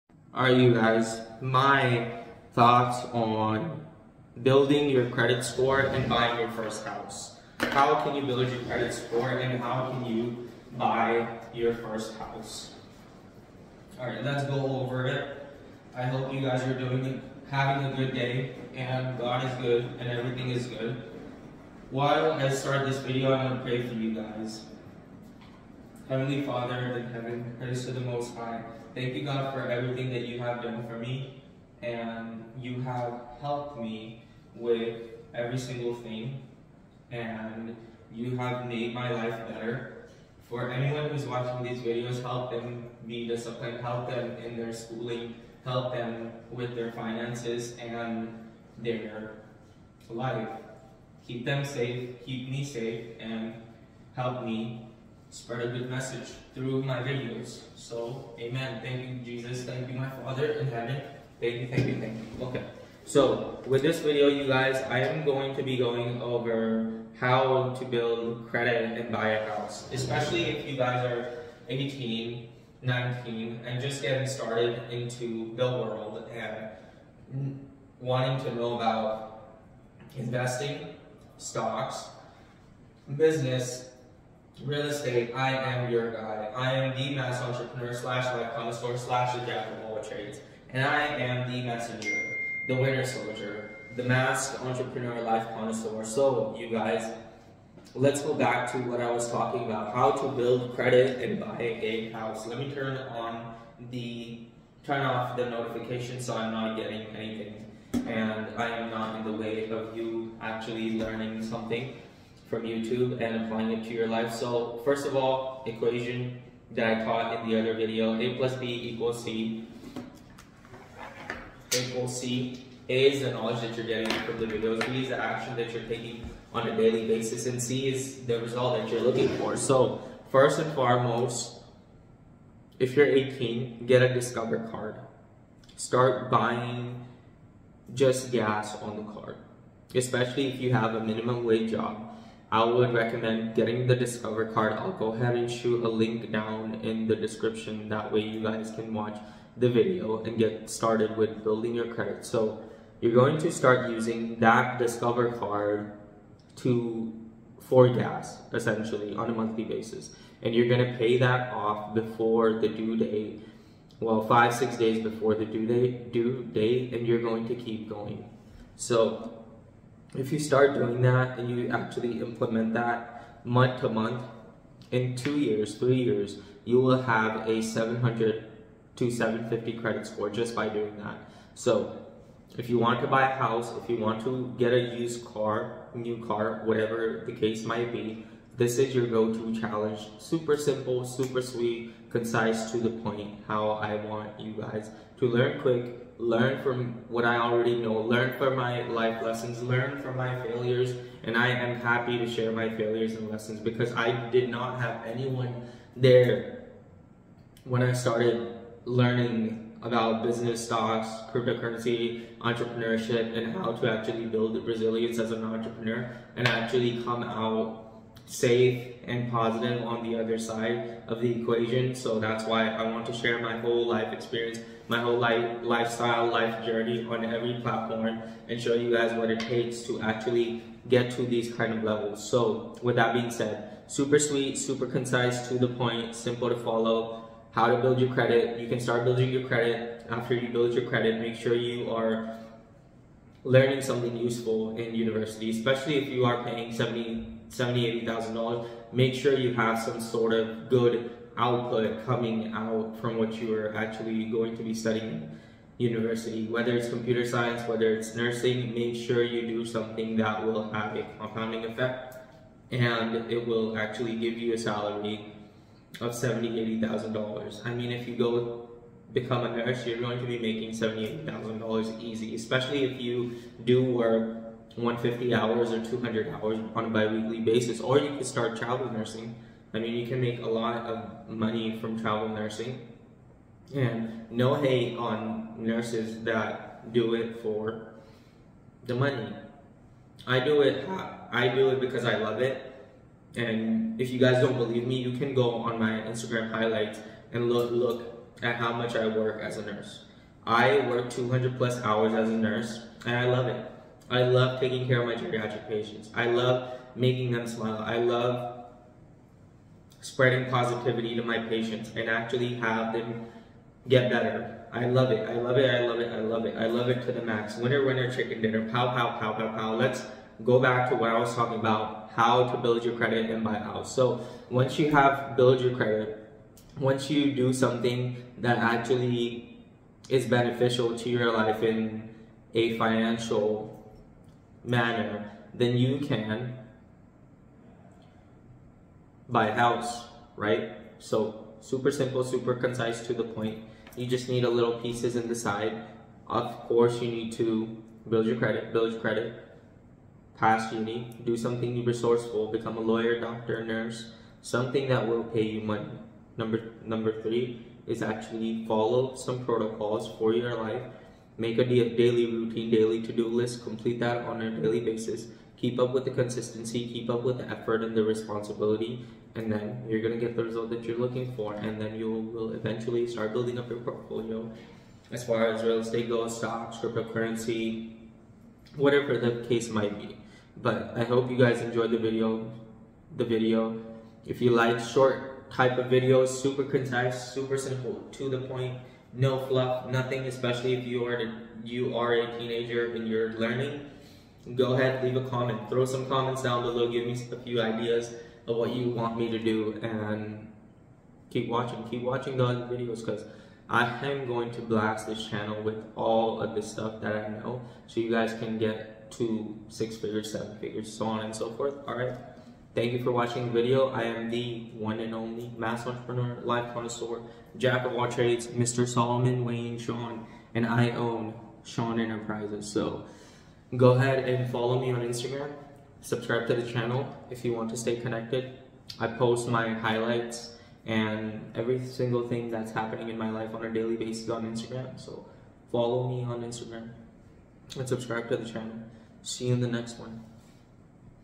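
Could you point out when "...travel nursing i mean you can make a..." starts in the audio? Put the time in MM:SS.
04:38.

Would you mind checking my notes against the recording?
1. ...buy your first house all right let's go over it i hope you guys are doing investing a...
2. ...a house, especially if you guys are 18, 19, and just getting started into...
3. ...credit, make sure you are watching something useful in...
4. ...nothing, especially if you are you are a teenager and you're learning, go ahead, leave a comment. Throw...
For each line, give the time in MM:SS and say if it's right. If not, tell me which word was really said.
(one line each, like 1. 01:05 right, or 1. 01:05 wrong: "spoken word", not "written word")
1. 00:10 wrong: "having", not "investing"
2. 01:09 right
3. 04:00 wrong: "learning", not "watching"
4. 06:29 right.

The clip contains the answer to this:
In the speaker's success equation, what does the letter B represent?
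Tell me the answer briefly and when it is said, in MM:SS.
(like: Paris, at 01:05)
Action, at 02:04.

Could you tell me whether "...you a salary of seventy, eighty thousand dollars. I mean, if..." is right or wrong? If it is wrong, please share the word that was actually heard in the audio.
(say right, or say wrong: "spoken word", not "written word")
right.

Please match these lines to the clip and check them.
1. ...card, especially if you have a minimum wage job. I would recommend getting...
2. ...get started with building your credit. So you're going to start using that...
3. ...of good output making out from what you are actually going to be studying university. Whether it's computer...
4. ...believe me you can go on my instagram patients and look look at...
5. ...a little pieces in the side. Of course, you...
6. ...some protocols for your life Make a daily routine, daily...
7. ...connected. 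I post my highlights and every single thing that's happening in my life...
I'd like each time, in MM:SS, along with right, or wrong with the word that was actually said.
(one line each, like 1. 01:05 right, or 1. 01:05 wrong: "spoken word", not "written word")
1. 02:19 right
2. 02:30 right
3. 04:10 wrong: "coming", not "making"
4. 04:54 wrong: "highlights", not "patients"
5. 05:44 right
6. 05:59 right
7. 07:07 right.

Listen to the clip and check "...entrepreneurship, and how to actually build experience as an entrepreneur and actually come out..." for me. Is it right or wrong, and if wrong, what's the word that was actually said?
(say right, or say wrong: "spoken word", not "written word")
wrong: "resilience", not "experience".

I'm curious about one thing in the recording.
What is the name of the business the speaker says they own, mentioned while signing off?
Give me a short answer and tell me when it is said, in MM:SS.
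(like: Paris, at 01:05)
Schon Enterprises, at 07:01.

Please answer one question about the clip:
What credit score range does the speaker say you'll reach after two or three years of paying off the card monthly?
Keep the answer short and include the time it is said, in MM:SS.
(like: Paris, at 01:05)
700 to 750, at 02:57.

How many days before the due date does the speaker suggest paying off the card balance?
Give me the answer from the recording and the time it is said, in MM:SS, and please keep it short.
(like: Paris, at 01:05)
5 or 6 days, at 02:44.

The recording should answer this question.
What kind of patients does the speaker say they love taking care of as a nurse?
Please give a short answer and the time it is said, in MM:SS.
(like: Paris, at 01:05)
Geriatric patients, at 05:05.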